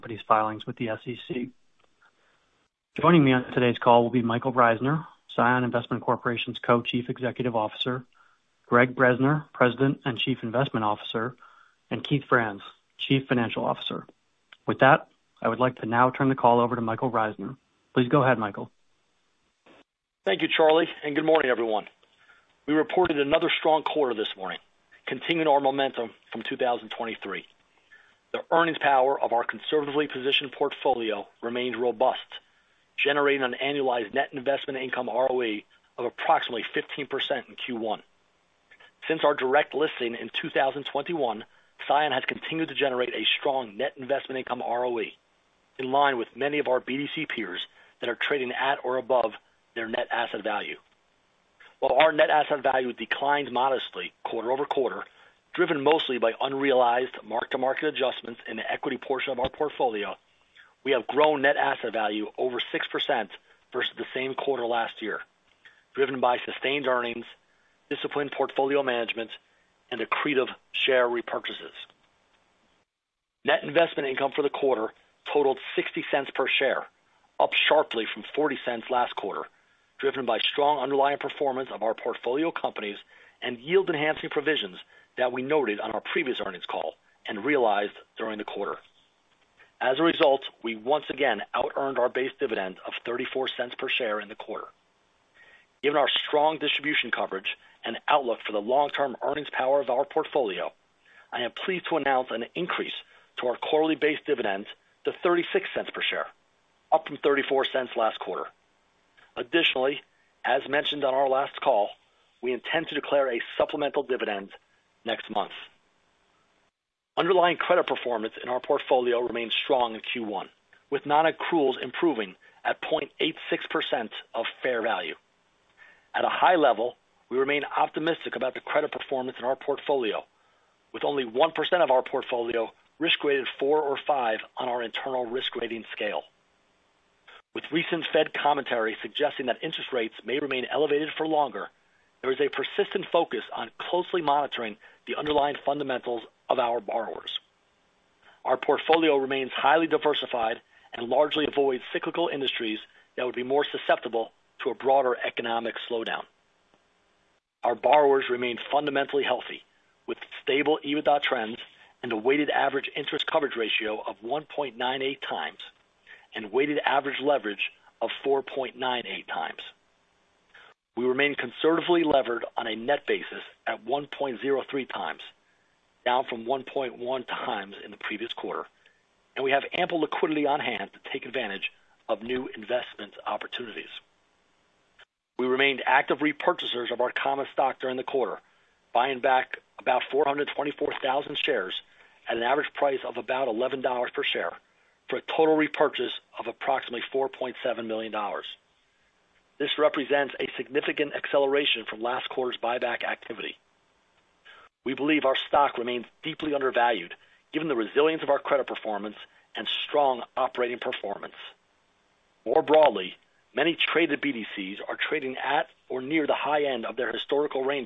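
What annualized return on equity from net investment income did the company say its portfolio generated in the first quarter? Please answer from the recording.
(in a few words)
15%.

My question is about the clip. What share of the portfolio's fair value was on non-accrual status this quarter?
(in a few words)
0.86%.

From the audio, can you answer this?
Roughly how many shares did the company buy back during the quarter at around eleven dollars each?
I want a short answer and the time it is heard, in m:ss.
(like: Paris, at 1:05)
424,000, at 3:10.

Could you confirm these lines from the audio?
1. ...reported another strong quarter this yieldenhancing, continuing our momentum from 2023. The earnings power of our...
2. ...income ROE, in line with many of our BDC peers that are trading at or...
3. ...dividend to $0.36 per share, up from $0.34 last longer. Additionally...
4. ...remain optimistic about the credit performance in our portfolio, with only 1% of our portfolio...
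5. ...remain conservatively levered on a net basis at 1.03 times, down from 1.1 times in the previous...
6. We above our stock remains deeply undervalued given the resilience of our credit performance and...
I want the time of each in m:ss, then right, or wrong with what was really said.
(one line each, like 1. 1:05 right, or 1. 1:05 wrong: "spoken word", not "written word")
1. 0:22 wrong: "morning", not "yieldenhancing"
2. 0:44 right
3. 1:44 wrong: "quarter", not "longer"
4. 2:07 right
5. 2:51 right
6. 3:24 wrong: "believe", not "above".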